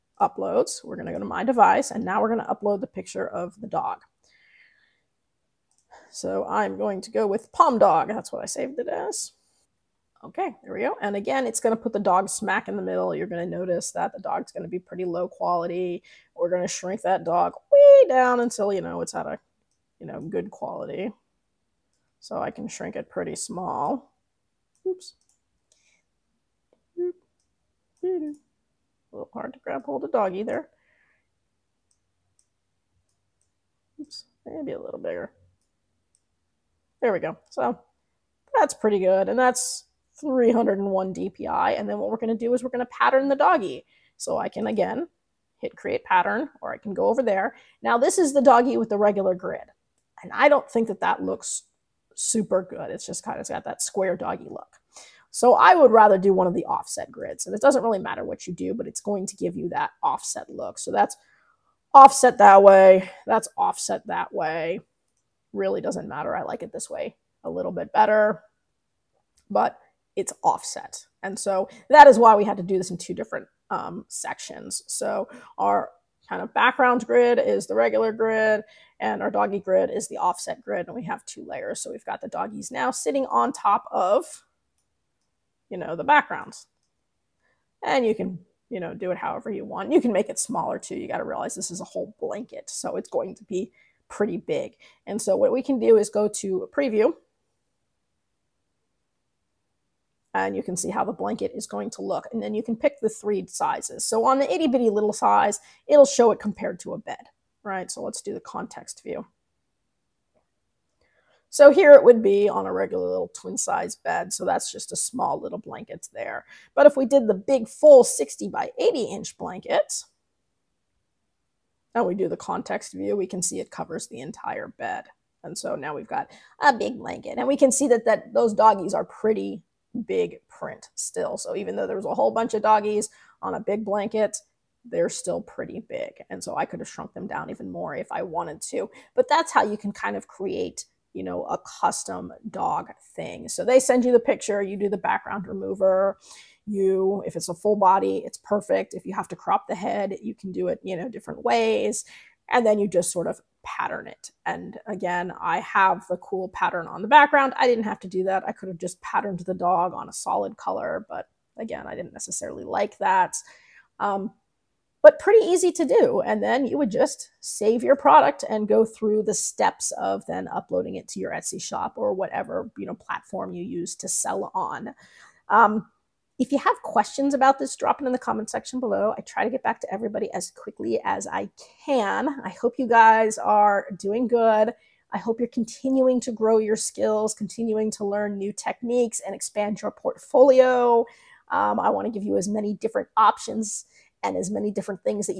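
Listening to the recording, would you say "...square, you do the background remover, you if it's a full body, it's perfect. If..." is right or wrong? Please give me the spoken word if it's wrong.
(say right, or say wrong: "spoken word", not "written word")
wrong: "picture", not "square".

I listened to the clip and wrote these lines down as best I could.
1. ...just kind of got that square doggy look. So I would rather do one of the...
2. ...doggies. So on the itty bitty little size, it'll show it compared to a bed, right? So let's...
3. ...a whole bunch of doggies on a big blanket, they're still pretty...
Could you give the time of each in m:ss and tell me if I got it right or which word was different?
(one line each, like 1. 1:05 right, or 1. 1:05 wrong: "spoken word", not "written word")
1. 0:53 right
2. 1:43 wrong: "sizes", not "doggies"
3. 2:12 right.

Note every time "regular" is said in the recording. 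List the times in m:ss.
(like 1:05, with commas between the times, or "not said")
0:48, 1:17, 1:52.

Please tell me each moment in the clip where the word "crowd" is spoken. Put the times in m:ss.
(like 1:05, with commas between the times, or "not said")
not said.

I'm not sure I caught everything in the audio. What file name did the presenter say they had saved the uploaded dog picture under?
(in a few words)
Pom Dog.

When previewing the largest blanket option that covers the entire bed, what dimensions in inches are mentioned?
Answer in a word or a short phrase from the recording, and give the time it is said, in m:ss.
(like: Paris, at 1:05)
60 by 80 inches, at 1:58.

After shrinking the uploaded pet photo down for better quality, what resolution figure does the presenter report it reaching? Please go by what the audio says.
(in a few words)
301 DPI.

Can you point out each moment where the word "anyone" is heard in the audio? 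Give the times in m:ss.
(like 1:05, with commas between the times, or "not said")
not said.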